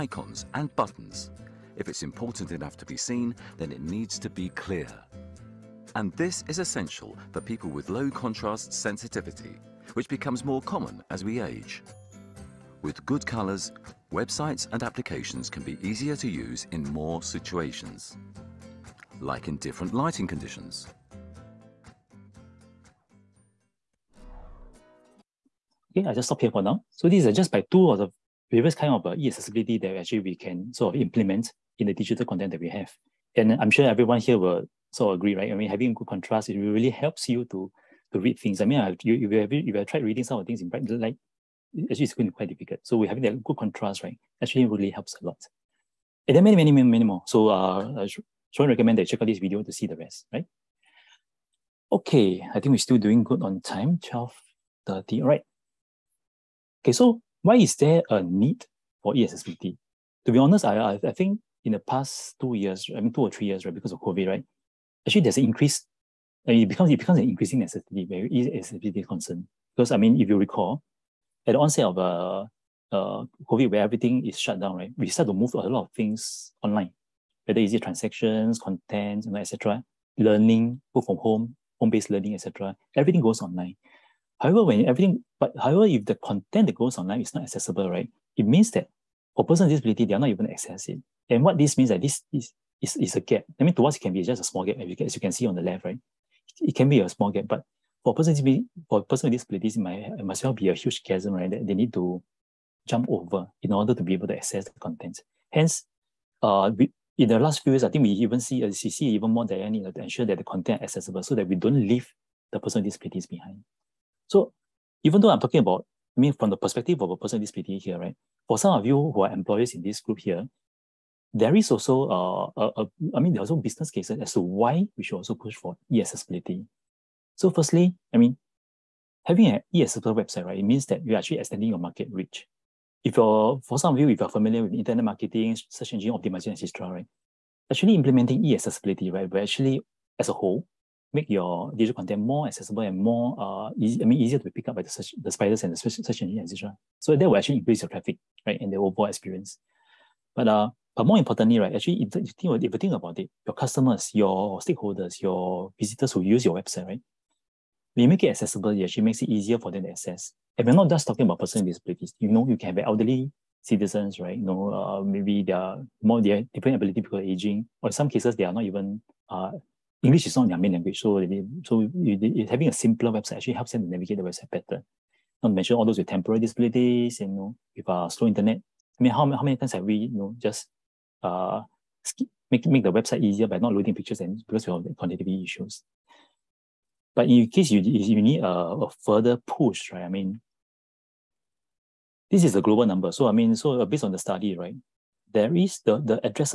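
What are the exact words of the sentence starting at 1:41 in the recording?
That they need to jump over in order to be able to access the content.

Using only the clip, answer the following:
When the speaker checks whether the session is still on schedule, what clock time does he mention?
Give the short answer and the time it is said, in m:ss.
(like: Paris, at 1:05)
12.30, at 0:53.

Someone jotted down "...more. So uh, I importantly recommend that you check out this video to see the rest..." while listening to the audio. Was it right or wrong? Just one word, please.
wrong.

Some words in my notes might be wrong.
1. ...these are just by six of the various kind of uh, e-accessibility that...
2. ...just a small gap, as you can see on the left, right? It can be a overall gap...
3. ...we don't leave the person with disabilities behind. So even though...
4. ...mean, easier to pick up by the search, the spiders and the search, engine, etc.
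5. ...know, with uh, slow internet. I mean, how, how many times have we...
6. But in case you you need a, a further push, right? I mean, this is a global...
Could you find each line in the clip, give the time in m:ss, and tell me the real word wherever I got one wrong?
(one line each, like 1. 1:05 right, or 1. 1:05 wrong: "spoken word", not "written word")
1. 0:27 wrong: "two", not "six"
2. 1:34 wrong: "small", not "overall"
3. 1:51 right
4. 2:24 right
5. 2:57 right
6. 3:07 right.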